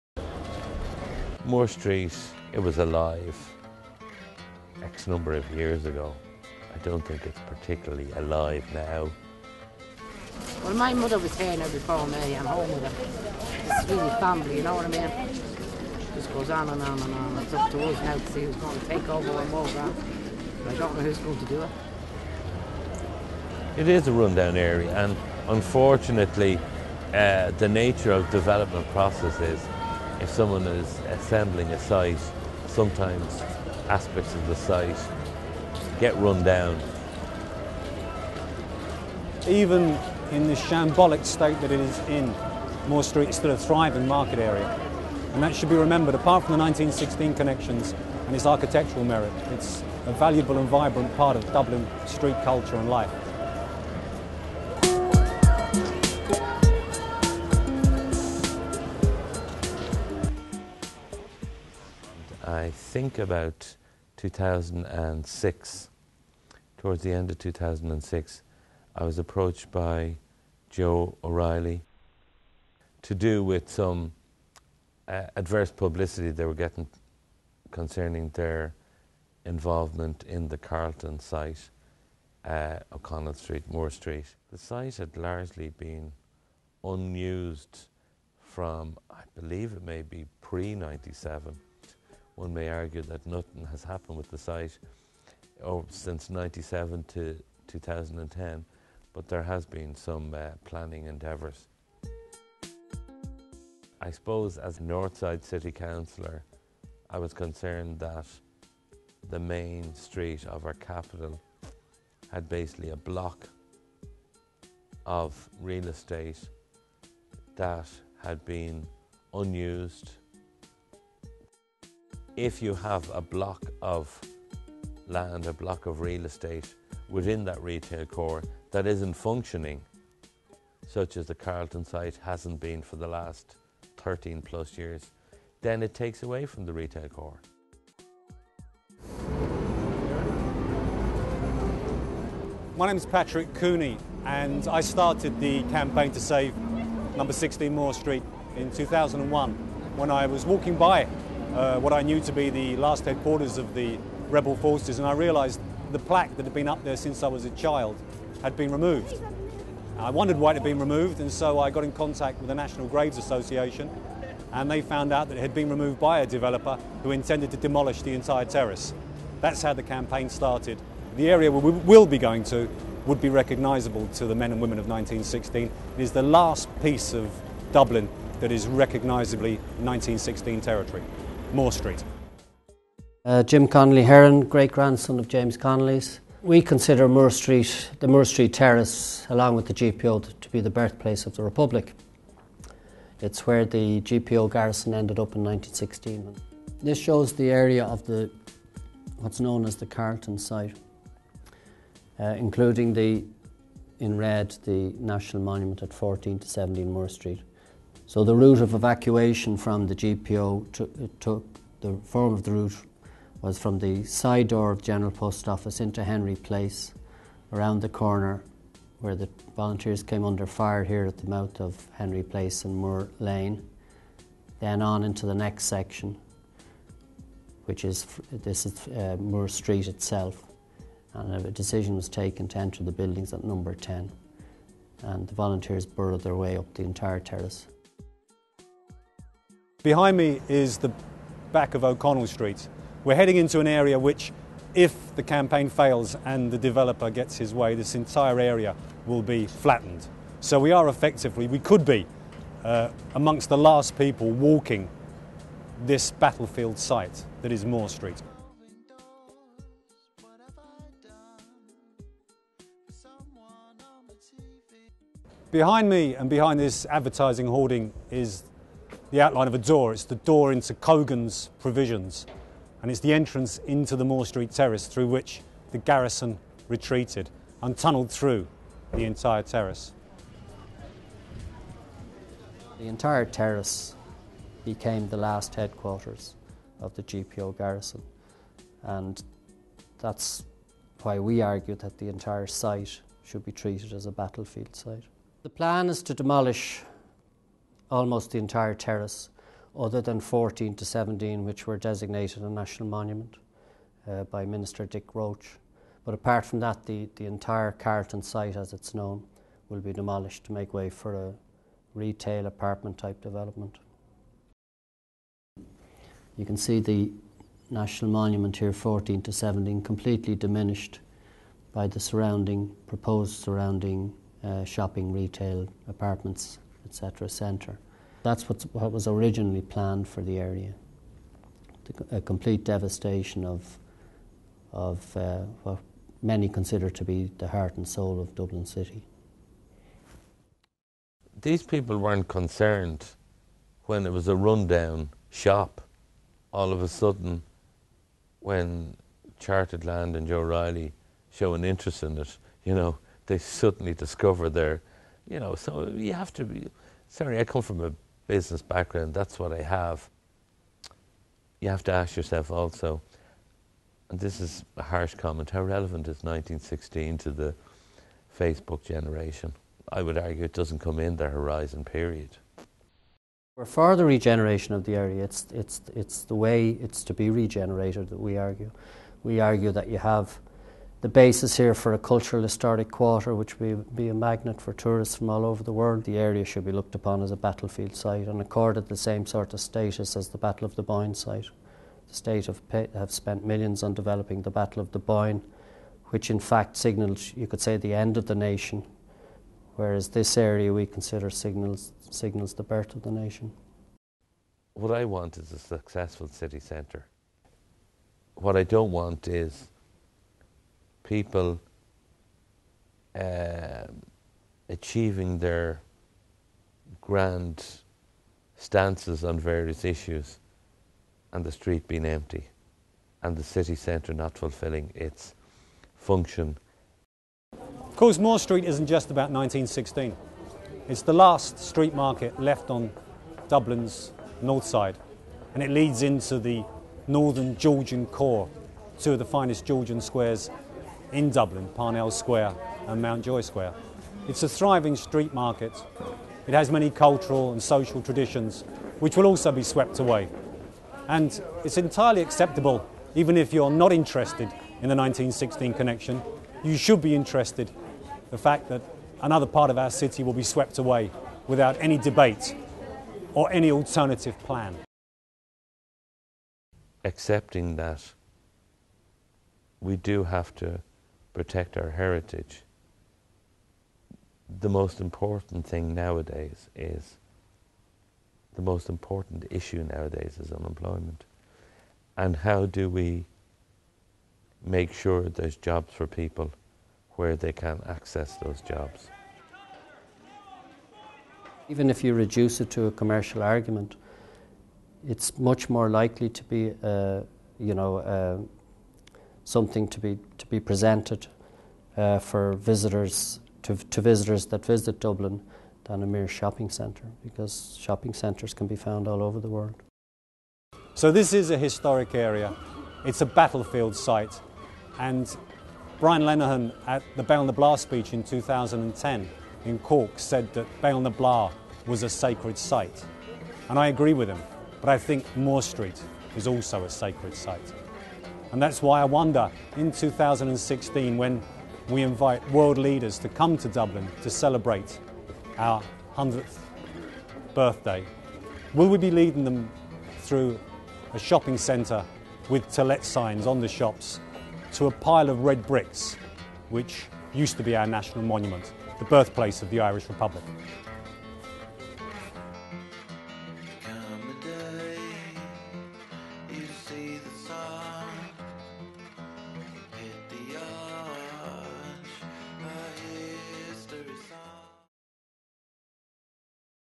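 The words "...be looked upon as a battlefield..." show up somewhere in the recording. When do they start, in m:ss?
6:26.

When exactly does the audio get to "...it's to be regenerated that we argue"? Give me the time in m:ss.
6:16.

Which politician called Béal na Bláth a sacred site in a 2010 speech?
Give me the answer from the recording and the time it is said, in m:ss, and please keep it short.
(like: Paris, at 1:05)
Brian Lenihan, at 8:35.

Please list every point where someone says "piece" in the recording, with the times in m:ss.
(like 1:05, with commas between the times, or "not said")
2:56.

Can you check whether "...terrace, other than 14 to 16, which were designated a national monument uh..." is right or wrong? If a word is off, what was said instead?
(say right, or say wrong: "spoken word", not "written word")
wrong: "17", not "16".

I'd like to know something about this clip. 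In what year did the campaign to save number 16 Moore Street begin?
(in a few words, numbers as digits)
2001.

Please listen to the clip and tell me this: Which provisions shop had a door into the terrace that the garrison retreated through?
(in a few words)
Cogan's.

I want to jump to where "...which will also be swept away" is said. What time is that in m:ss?
7:28.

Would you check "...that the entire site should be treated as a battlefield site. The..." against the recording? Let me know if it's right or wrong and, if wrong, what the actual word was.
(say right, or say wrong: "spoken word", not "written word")
right.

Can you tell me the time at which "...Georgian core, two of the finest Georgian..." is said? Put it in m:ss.
7:17.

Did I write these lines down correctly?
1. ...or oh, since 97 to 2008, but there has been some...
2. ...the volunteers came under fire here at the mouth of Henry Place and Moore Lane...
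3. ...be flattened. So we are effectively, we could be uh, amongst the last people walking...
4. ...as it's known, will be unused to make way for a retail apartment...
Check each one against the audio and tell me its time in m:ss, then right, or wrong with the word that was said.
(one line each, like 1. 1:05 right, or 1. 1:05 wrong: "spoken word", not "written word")
1. 1:35 wrong: "2010", not "2008"
2. 3:39 right
3. 4:09 right
4. 5:08 wrong: "demolished", not "unused".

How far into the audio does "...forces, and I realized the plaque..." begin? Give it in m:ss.
2:34.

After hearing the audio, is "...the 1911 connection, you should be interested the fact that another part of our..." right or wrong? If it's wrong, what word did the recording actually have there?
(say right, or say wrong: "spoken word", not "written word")
wrong: "1916", not "1911".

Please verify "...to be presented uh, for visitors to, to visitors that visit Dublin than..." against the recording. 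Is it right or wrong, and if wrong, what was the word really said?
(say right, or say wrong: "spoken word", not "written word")
right.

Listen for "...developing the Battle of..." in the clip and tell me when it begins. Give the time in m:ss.
6:33.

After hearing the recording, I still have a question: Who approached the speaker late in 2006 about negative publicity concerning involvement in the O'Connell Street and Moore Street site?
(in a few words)
Joe O'Reilly.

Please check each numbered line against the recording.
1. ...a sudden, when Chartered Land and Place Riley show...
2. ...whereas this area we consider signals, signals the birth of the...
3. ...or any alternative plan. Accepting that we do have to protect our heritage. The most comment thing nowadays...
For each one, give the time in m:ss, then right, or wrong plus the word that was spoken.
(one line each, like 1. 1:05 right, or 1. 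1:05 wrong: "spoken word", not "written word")
1. 5:46 wrong: "Joe", not "Place"
2. 6:39 right
3. 7:43 wrong: "important", not "comment".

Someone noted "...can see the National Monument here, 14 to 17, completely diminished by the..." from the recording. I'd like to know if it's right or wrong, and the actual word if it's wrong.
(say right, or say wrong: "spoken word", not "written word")
right.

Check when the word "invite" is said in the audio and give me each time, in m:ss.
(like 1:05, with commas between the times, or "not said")
8:52.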